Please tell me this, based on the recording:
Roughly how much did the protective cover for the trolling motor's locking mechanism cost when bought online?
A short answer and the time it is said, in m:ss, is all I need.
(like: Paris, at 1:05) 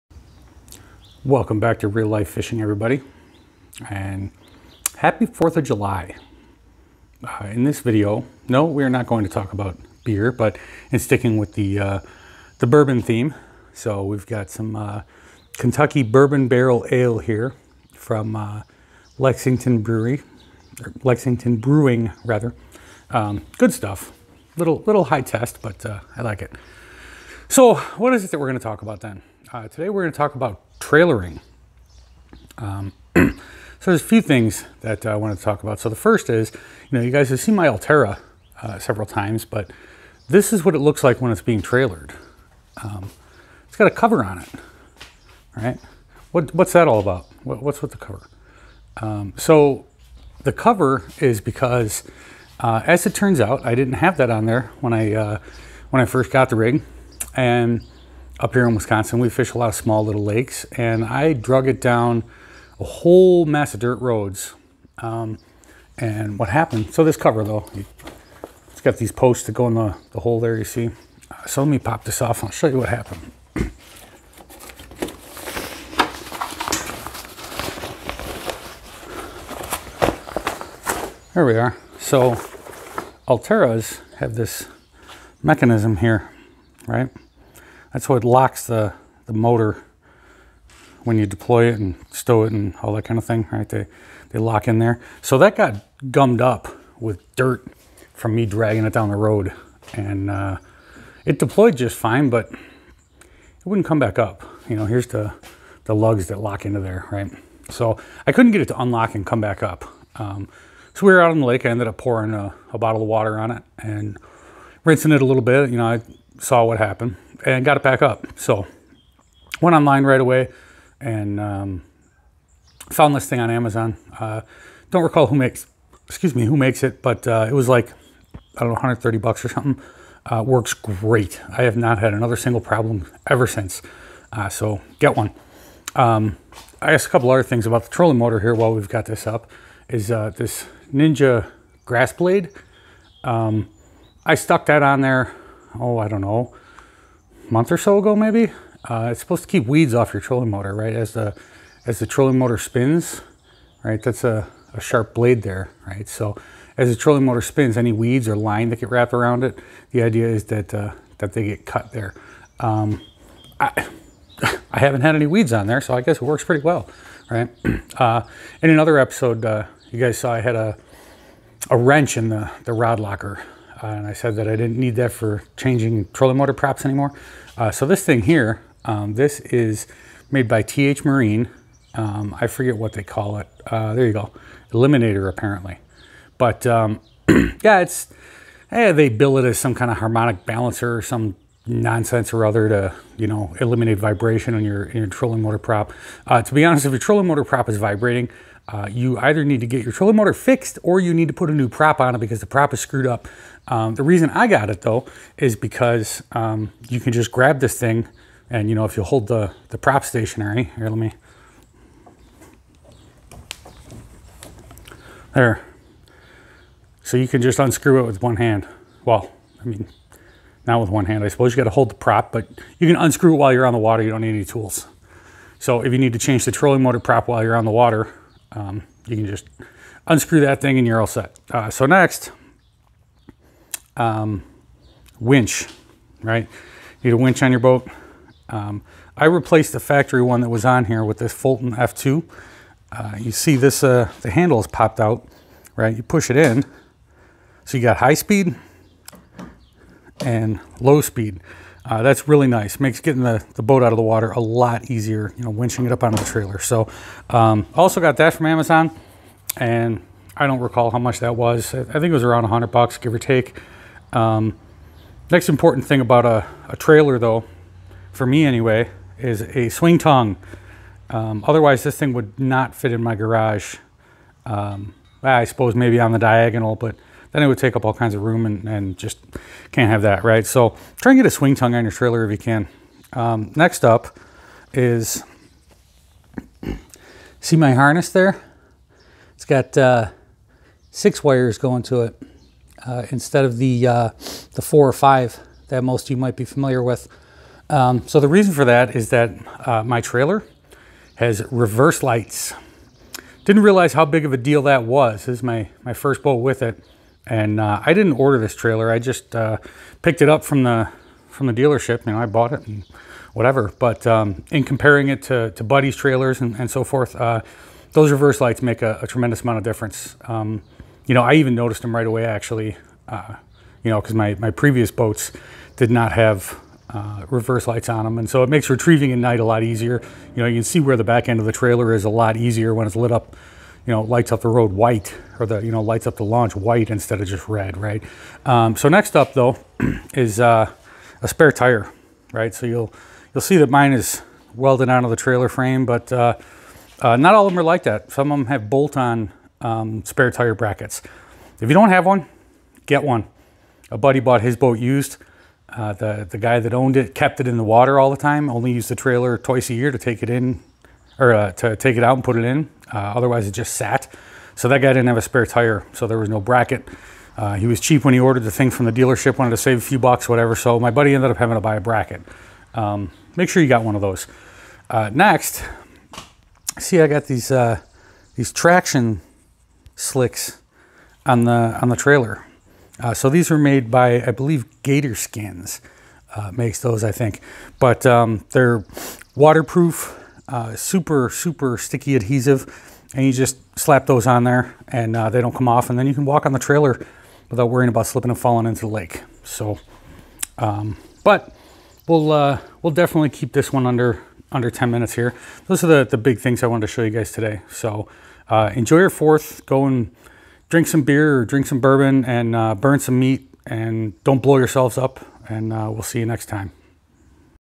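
130 bucks, at 2:08.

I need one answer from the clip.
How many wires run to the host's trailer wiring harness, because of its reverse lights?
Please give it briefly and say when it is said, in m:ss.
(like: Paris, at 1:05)
6, at 4:50.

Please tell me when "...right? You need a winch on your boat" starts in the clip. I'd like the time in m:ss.
3:56.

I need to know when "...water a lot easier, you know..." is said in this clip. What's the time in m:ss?
4:14.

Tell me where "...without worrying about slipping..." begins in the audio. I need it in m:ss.
6:37.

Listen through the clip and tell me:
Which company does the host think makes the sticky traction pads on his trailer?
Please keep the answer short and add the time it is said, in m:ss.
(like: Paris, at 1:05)
Gator Skins, at 6:24.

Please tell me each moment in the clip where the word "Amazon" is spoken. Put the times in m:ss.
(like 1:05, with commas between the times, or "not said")
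2:03, 4:18.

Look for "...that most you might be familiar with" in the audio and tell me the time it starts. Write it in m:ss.
4:55.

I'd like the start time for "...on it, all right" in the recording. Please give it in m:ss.
0:44.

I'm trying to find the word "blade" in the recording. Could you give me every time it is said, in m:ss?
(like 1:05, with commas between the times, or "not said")
2:22, 2:35.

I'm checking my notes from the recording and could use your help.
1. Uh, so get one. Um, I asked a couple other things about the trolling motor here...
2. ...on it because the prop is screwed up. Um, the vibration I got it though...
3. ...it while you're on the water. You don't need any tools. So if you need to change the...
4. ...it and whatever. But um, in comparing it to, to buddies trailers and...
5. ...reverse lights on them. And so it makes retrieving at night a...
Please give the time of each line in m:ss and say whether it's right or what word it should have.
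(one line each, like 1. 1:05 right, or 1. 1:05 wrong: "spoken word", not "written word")
1. 2:14 right
2. 3:21 wrong: "reason", not "vibration"
3. 3:43 right
4. 5:12 right
5. 5:27 right.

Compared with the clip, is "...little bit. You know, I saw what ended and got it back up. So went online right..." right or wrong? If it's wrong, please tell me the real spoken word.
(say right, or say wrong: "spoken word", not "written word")
wrong: "happened", not "ended".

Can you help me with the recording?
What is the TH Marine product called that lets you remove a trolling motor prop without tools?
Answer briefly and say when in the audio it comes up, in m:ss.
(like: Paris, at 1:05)
Eliminator, at 3:04.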